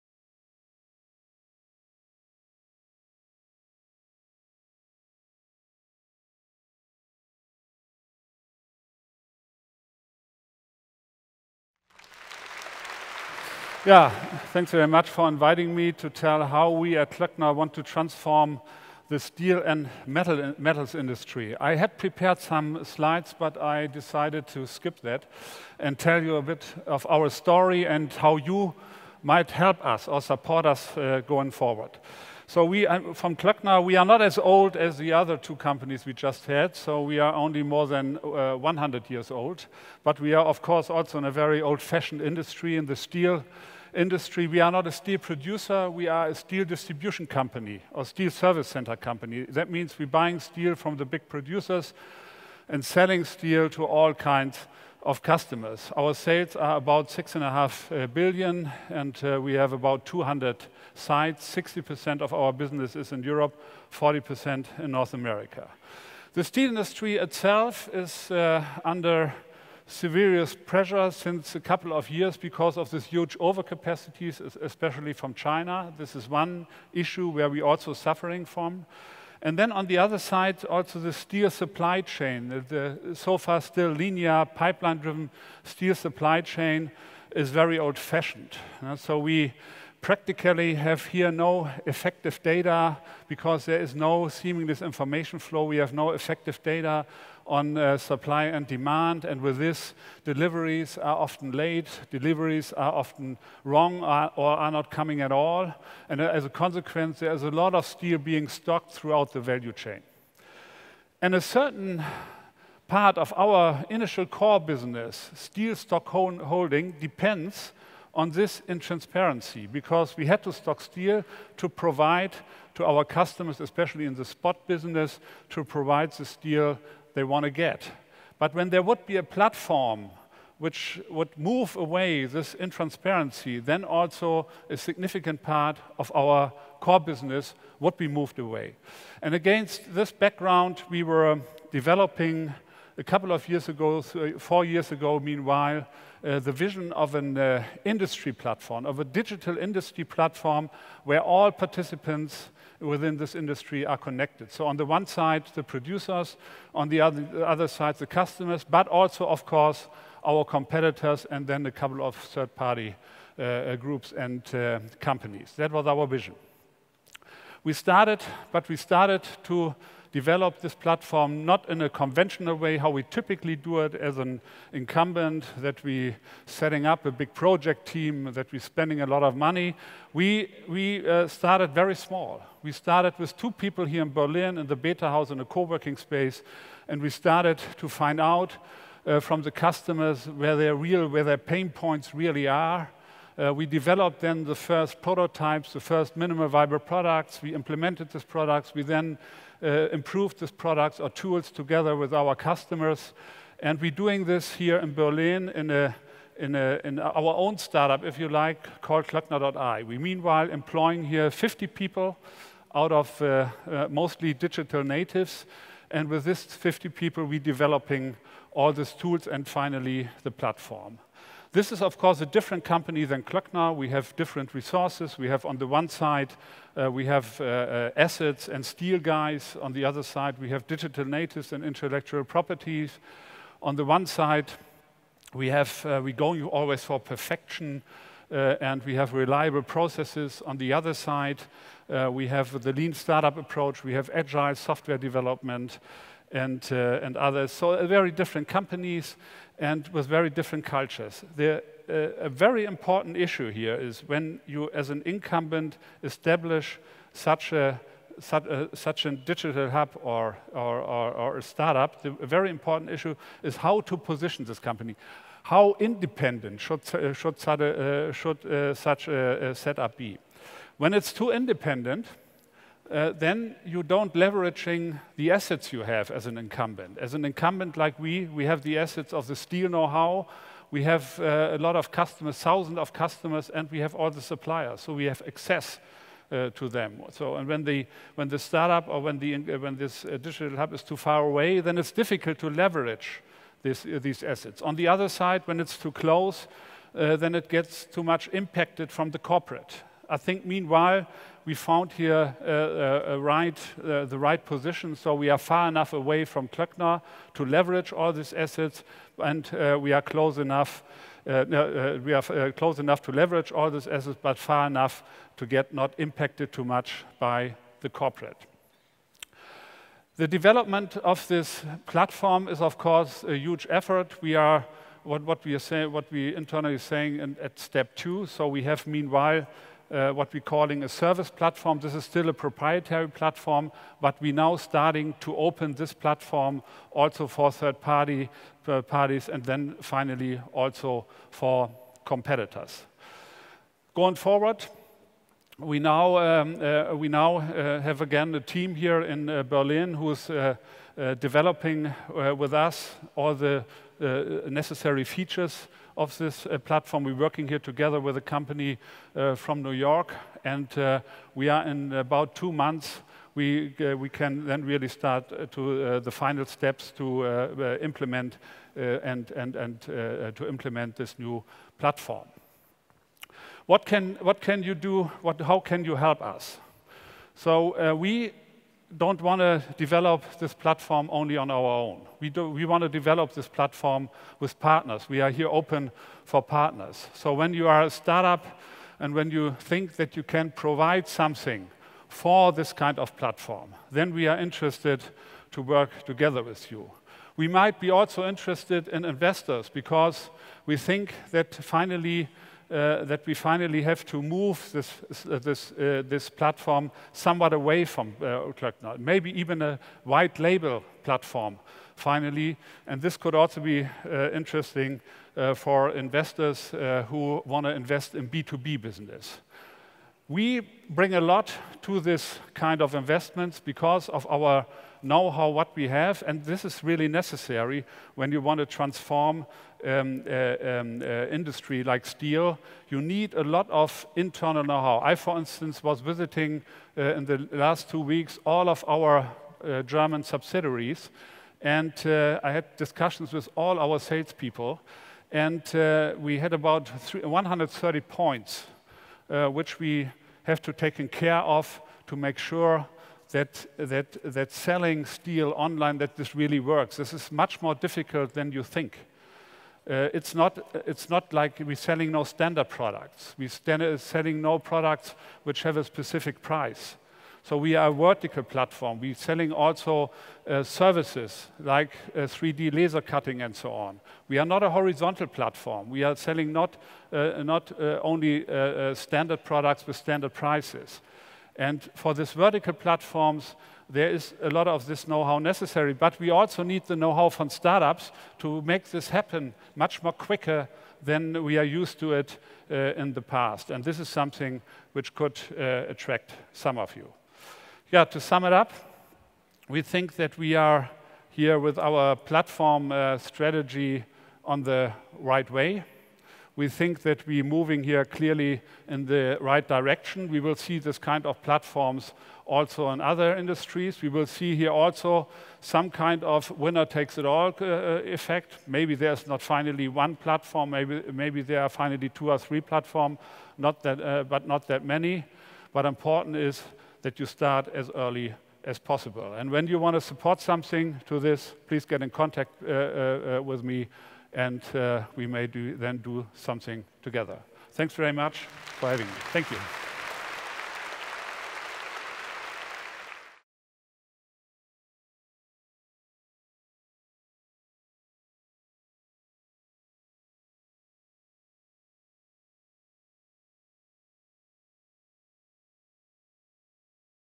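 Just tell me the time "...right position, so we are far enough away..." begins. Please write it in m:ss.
5:04.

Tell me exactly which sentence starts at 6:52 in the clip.
And this could also be uh, interesting for investors who want to invest in B2B business.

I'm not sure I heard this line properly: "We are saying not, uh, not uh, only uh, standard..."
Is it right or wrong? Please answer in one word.
wrong.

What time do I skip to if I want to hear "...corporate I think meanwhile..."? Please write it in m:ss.
4:59.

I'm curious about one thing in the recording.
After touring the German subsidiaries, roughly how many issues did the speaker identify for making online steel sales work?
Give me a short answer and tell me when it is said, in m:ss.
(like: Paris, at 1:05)
130, at 7:27.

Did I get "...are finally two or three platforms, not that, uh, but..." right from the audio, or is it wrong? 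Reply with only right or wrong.
right.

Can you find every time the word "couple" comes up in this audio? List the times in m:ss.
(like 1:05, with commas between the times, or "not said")
1:11, 2:23, 2:41.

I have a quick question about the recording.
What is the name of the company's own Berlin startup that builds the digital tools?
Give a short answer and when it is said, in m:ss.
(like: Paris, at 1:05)
Klöckner.i, at 3:29.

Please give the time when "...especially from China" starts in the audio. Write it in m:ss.
1:14.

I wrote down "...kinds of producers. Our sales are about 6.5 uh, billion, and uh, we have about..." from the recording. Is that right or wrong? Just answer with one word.
wrong.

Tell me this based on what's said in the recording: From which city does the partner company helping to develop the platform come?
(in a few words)
New York.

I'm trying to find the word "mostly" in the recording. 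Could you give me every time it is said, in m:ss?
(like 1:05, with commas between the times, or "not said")
3:33.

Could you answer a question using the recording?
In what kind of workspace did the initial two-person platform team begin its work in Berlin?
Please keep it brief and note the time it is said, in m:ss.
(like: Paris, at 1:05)
Betahaus, at 3:04.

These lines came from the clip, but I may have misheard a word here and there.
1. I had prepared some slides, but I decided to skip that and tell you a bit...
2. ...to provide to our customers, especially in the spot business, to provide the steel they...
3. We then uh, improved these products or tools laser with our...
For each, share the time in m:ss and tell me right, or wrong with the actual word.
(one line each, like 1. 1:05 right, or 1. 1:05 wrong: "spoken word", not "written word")
1. 0:21 right
2. 2:01 right
3. 3:18 wrong: "together", not "laser".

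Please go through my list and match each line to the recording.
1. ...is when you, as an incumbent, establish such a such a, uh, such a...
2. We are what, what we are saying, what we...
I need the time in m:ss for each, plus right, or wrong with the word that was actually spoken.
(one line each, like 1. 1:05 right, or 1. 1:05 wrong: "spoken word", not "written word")
1. 4:13 right
2. 5:24 right.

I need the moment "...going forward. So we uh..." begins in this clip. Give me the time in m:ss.
0:31.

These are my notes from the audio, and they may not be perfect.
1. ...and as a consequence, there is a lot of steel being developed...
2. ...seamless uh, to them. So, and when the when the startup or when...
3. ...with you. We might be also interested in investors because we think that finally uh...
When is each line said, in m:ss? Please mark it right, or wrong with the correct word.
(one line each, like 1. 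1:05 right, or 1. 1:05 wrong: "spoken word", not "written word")
1. 1:46 wrong: "stocked", not "developed"
2. 4:45 wrong: "access", not "seamless"
3. 6:36 right.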